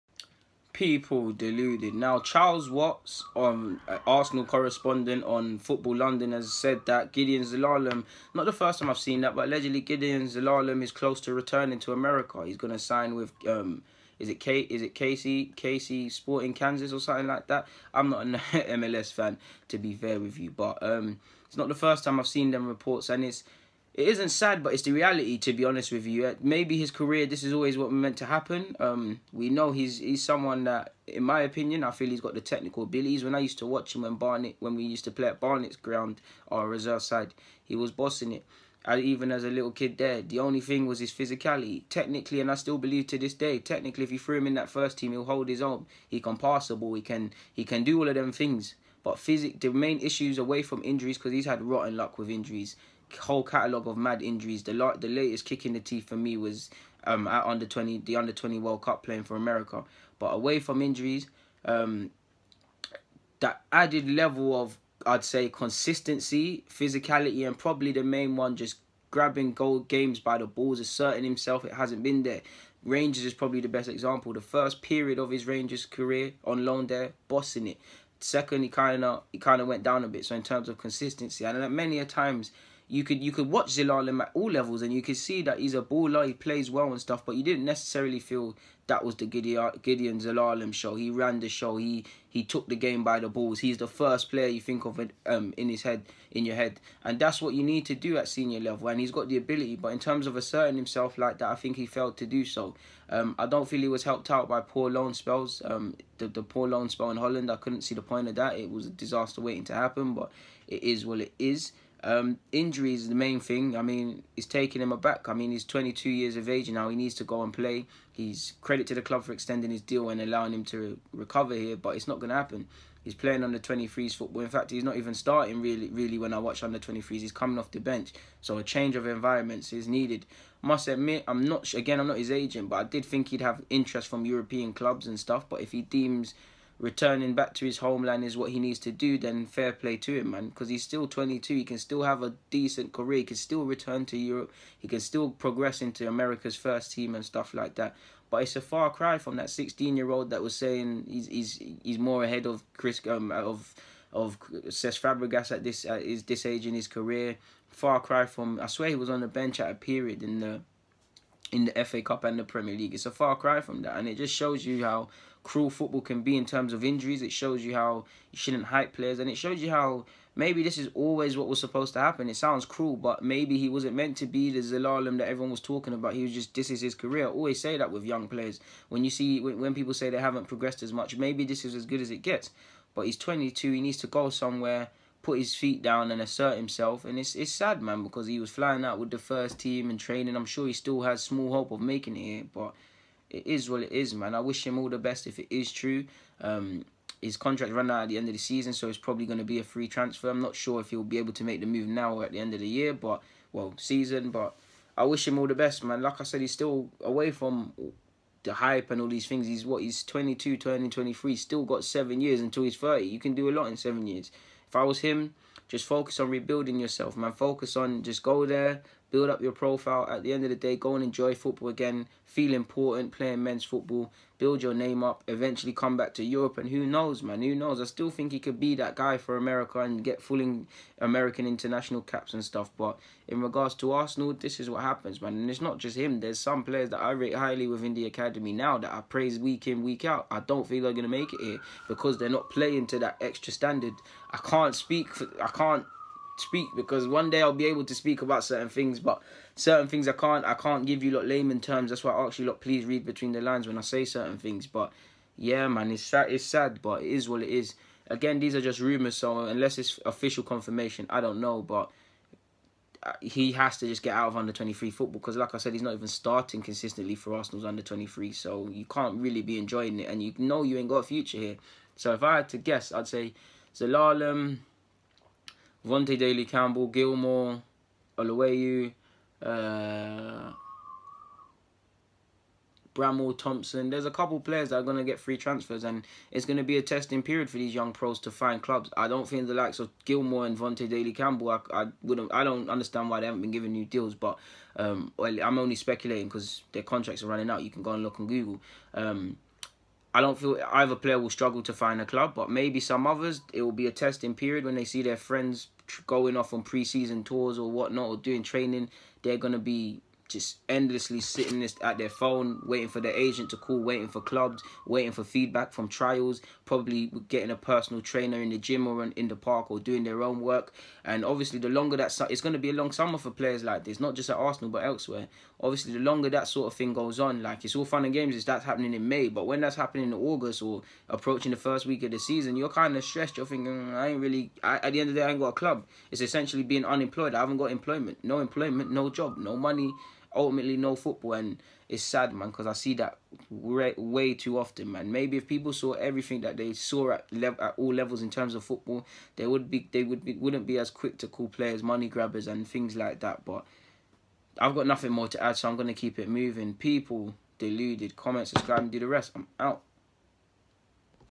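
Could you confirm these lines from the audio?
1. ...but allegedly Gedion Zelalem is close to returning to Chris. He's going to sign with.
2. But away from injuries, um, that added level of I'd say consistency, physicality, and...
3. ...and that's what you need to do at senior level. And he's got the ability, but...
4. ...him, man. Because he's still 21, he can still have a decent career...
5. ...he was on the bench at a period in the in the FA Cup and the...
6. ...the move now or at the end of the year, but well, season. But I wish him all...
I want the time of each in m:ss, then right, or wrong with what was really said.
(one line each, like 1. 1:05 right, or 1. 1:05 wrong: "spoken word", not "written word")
1. 0:09 wrong: "America", not "Chris"
2. 1:00 right
3. 1:37 right
4. 2:20 wrong: "22", not "21"
5. 2:38 right
6. 3:21 right.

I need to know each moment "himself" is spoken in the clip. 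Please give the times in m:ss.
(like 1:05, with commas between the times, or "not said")
1:11, 1:40, 3:06.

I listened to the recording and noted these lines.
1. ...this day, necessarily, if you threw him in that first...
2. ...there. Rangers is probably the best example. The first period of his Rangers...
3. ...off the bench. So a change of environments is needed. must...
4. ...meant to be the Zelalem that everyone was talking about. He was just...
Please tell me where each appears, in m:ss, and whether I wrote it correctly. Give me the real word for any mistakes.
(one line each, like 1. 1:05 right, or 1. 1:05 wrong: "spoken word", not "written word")
1. 0:43 wrong: "technically", not "necessarily"
2. 1:12 right
3. 2:07 right
4. 2:53 right.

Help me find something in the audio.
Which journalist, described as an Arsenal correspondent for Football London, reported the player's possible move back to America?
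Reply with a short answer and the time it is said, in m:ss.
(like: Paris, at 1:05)
Charles Watts, at 0:02.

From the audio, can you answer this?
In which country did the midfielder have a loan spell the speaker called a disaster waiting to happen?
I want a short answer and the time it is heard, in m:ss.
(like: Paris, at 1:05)
Holland, at 1:47.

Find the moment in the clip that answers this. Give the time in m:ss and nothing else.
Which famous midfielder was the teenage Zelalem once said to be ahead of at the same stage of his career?
2:34.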